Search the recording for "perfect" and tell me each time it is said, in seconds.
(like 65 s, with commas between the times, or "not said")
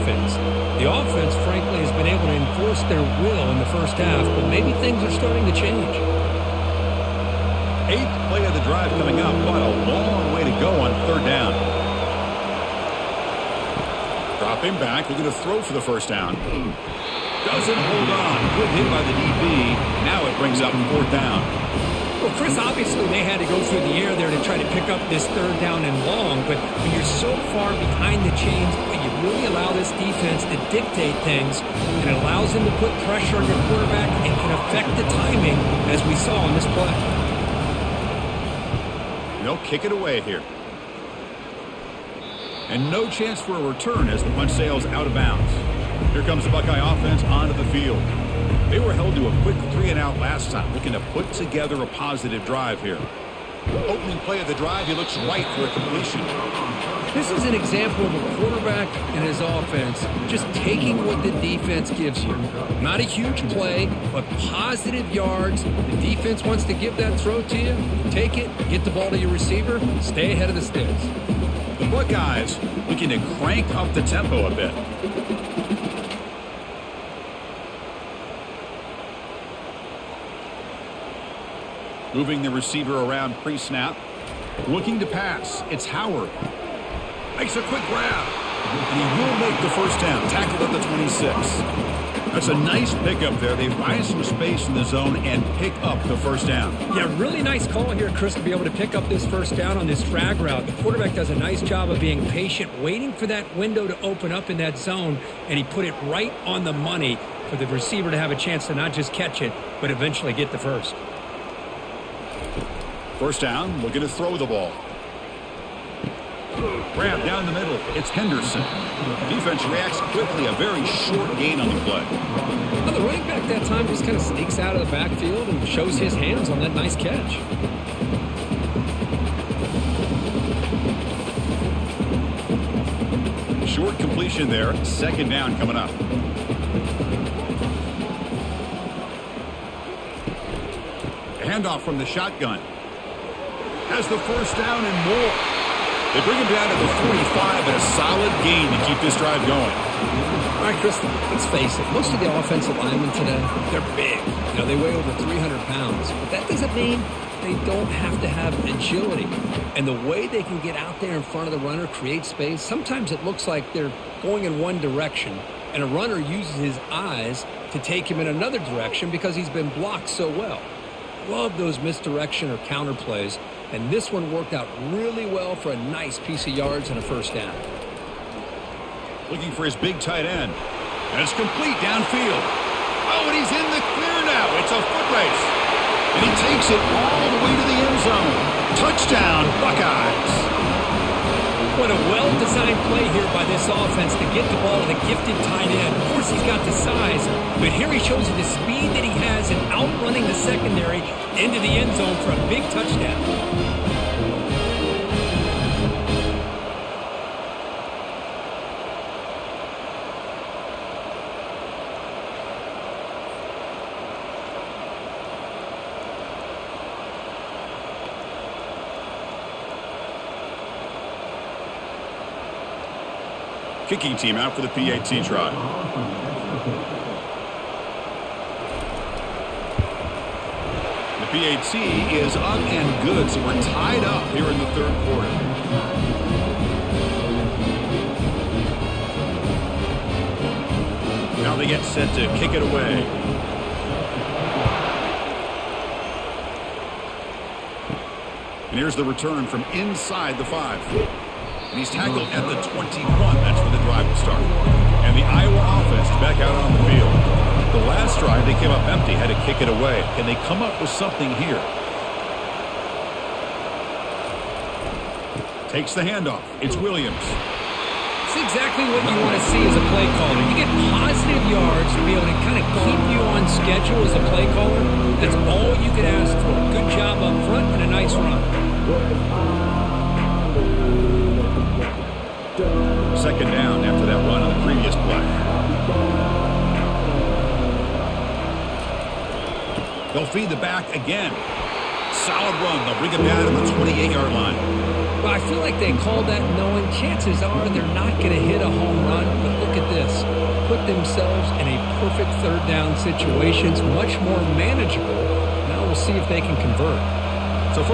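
302 s.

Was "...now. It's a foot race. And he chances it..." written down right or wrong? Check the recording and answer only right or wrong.
wrong.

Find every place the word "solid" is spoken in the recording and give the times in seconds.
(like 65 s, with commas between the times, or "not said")
147 s, 292 s.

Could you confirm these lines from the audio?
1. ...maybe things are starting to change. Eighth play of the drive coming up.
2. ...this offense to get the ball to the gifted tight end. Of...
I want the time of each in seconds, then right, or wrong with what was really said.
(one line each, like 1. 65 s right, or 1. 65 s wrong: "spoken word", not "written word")
1. 4 s right
2. 193 s right.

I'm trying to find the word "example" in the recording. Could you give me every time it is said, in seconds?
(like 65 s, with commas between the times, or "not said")
57 s.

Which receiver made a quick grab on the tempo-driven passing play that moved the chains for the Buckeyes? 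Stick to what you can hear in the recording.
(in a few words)
Howard.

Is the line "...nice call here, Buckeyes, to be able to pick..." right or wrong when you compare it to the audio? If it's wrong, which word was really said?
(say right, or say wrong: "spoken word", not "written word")
wrong: "Chris", not "Buckeyes".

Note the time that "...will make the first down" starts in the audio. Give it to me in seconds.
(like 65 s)
89 s.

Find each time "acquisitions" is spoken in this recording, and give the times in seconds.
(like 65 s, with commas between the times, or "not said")
not said.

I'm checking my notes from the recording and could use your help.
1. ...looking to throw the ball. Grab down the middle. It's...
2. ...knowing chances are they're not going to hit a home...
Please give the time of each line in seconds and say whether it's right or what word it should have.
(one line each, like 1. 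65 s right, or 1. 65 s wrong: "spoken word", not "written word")
1. 113 s right
2. 296 s right.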